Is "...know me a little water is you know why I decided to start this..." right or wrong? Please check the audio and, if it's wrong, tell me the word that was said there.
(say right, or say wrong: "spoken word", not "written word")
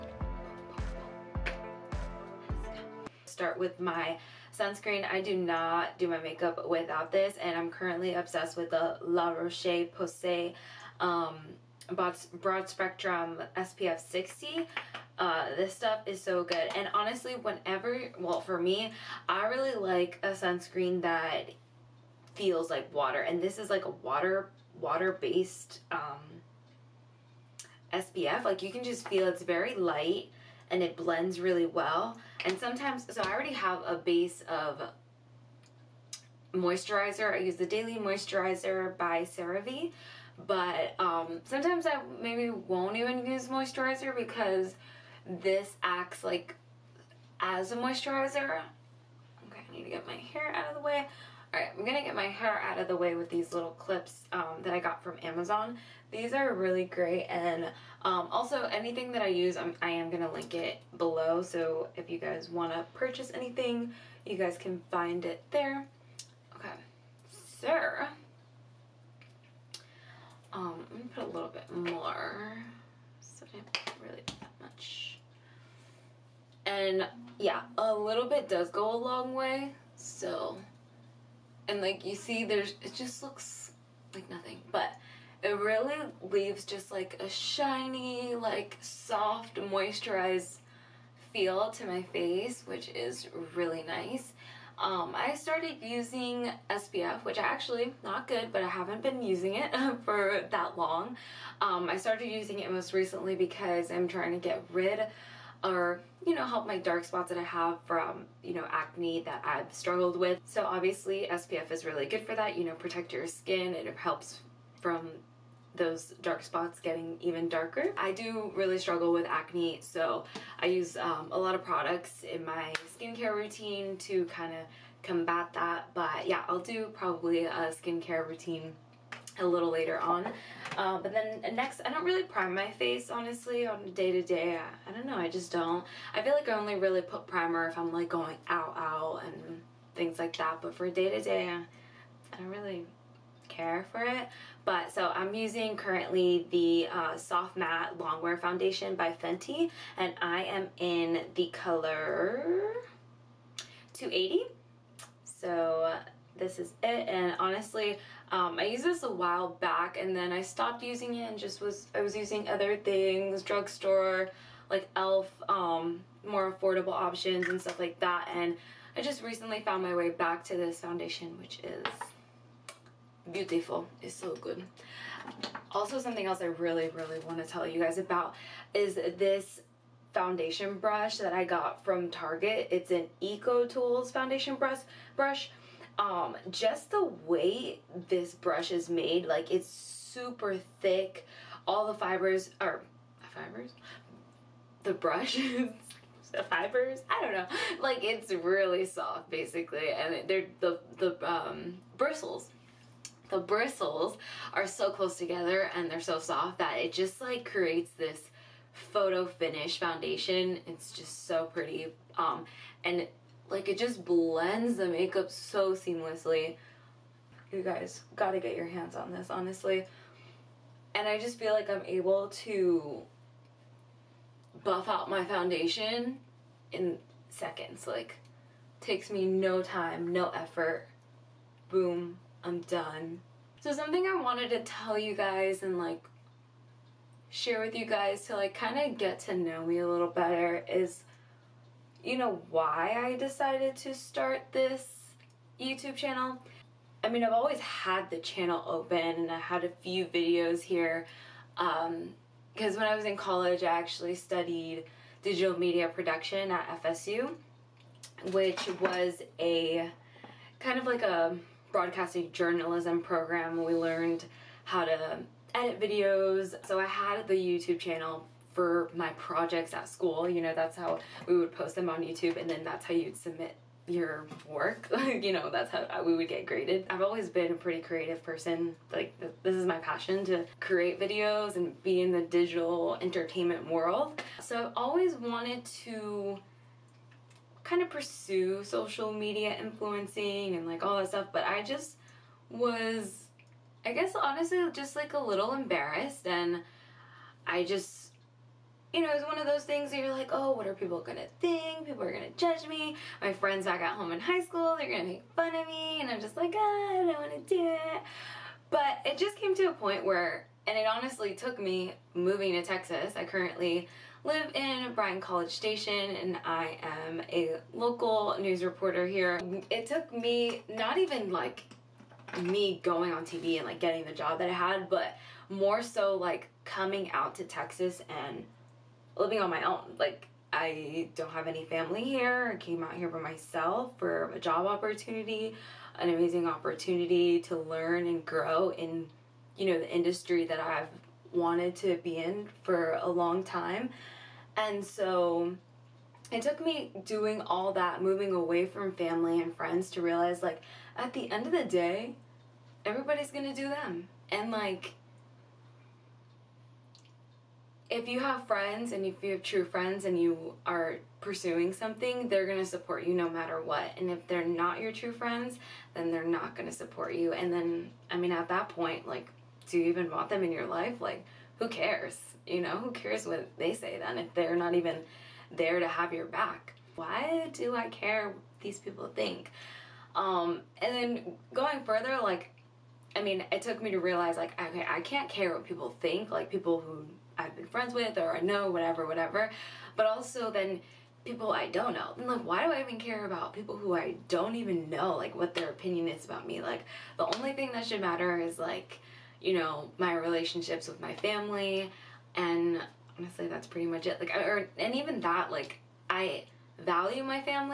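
wrong: "better", not "water".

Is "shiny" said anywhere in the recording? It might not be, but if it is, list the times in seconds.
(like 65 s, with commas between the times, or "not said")
87 s.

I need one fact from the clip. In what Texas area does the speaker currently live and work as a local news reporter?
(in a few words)
Bryan College Station.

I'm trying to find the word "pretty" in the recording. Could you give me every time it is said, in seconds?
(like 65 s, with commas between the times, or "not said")
211 s, 277 s, 403 s.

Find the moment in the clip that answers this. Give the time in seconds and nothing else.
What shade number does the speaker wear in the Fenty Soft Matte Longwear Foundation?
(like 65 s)
153 s.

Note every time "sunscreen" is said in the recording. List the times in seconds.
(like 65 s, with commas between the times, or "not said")
4 s, 20 s.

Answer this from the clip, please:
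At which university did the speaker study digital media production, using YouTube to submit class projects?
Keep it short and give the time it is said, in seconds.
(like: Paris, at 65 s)
FSU, at 256 s.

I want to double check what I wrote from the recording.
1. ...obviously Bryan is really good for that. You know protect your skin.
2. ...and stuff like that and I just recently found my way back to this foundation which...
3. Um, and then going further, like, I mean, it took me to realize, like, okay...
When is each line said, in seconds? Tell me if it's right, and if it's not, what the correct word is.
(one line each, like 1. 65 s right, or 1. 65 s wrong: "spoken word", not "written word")
1. 110 s wrong: "SPF", not "Bryan"
2. 167 s right
3. 380 s right.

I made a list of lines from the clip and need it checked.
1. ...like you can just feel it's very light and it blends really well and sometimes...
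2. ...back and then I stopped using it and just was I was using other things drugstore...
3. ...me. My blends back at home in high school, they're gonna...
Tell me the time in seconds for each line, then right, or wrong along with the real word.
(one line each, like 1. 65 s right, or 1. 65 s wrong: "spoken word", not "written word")
1. 28 s right
2. 159 s right
3. 302 s wrong: "friends", not "blends".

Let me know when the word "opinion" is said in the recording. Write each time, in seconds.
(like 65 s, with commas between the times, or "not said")
395 s.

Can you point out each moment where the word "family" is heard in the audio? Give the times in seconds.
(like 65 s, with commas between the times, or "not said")
331 s, 348 s, 401 s.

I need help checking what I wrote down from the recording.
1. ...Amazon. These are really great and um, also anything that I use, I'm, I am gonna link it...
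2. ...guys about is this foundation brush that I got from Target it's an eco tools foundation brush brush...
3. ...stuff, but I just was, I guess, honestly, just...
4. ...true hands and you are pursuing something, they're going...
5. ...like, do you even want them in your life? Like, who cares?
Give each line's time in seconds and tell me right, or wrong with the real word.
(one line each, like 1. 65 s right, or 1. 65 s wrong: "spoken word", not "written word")
1. 55 s right
2. 177 s right
3. 291 s right
4. 359 s wrong: "friends", not "hands"
5. 369 s right.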